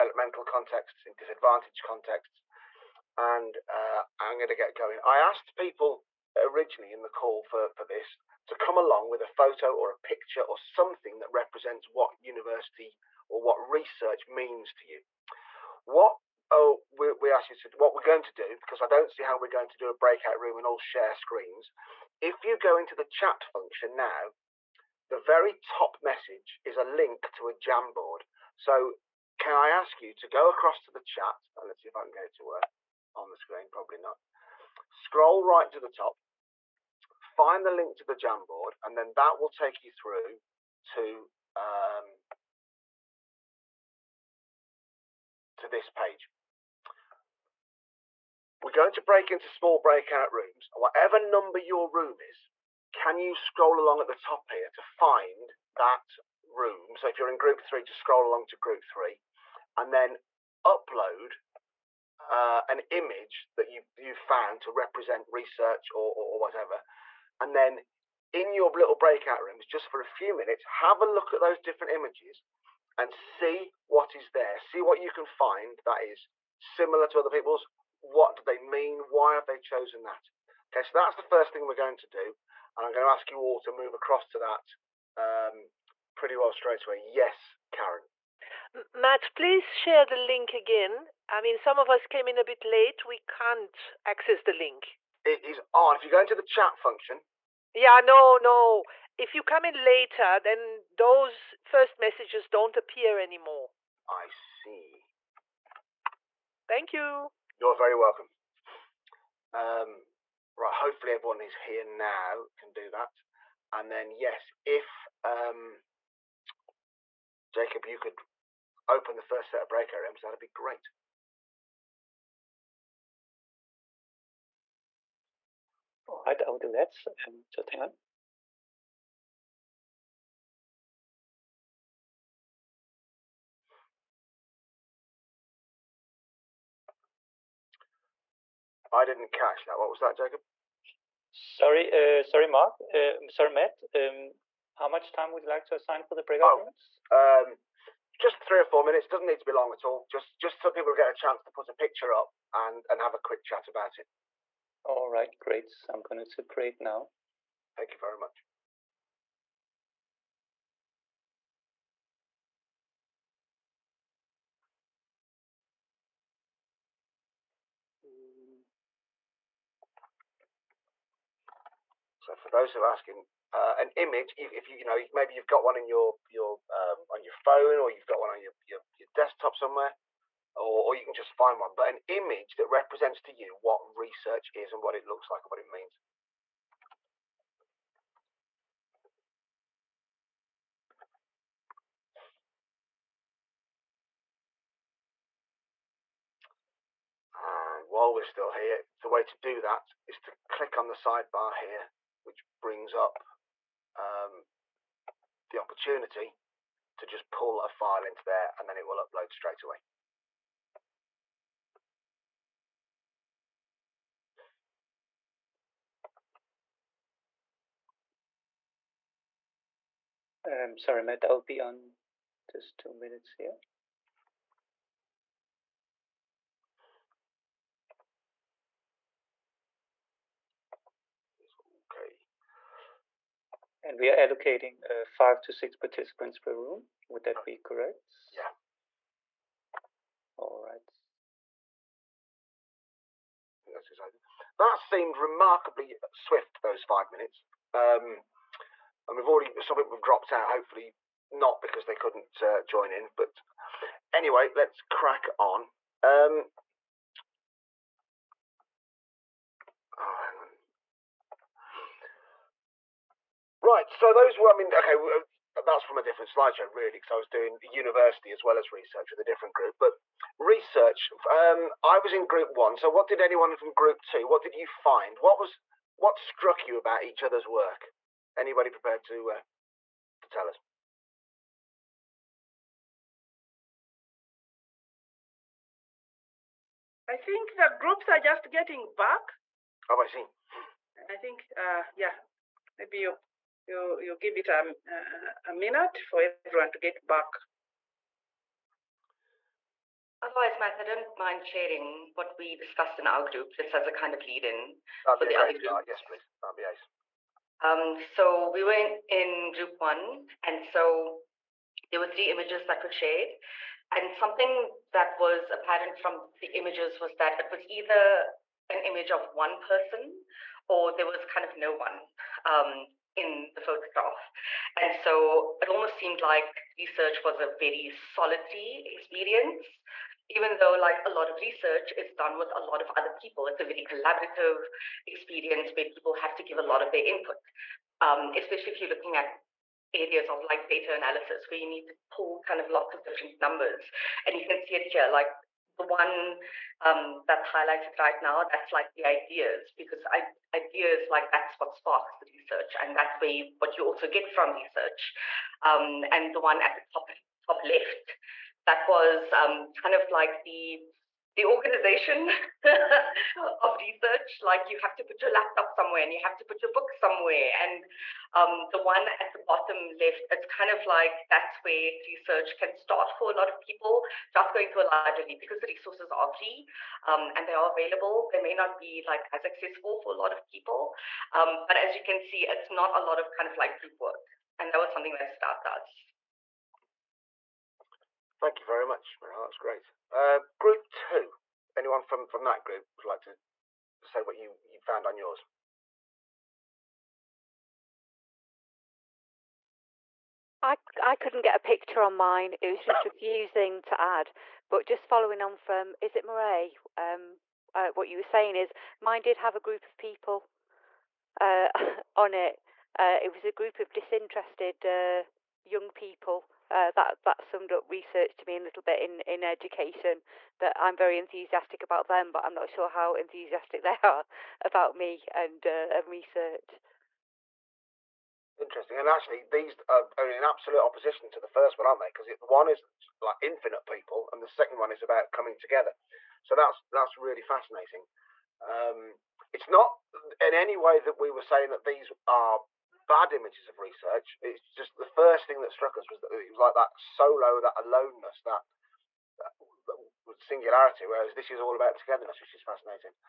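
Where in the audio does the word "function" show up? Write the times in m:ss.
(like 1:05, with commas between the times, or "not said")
0:23, 1:36.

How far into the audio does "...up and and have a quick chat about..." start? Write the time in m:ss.
2:32.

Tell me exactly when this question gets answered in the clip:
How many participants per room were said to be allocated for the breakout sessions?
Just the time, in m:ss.
3:55.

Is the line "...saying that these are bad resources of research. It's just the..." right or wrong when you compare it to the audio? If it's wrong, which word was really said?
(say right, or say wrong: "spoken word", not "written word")
wrong: "images", not "resources".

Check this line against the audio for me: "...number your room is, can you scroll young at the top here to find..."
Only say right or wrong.
wrong.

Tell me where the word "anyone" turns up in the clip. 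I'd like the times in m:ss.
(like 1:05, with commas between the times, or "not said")
4:33, 6:31.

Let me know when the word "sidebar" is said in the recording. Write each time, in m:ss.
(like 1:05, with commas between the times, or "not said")
3:20.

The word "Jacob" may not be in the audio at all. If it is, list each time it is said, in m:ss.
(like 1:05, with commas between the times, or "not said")
1:57, 2:20.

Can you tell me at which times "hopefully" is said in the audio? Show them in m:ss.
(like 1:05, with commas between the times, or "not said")
1:50, 4:10.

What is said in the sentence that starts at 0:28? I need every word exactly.
So can I ask you to go across to the chat?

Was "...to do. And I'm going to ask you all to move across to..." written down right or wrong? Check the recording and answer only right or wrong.
right.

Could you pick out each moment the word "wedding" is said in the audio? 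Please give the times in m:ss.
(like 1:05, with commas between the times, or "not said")
not said.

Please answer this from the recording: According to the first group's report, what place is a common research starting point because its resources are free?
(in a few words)
a library.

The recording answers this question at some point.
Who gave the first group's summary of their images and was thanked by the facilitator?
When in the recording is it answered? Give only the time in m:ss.
6:29.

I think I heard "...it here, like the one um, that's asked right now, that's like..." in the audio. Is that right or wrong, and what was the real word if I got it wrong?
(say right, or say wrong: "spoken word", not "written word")
wrong: "highlighted", not "asked".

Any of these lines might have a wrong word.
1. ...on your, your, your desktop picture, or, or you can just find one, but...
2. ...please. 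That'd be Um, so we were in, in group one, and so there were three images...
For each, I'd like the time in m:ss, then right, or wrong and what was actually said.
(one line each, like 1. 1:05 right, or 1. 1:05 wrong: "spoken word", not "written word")
1. 2:58 wrong: "somewhere", not "picture"
2. 5:06 right.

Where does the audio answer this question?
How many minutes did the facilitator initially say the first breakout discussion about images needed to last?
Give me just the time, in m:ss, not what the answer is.
2:28.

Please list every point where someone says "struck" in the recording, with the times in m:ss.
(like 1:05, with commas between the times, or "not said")
4:36, 7:25.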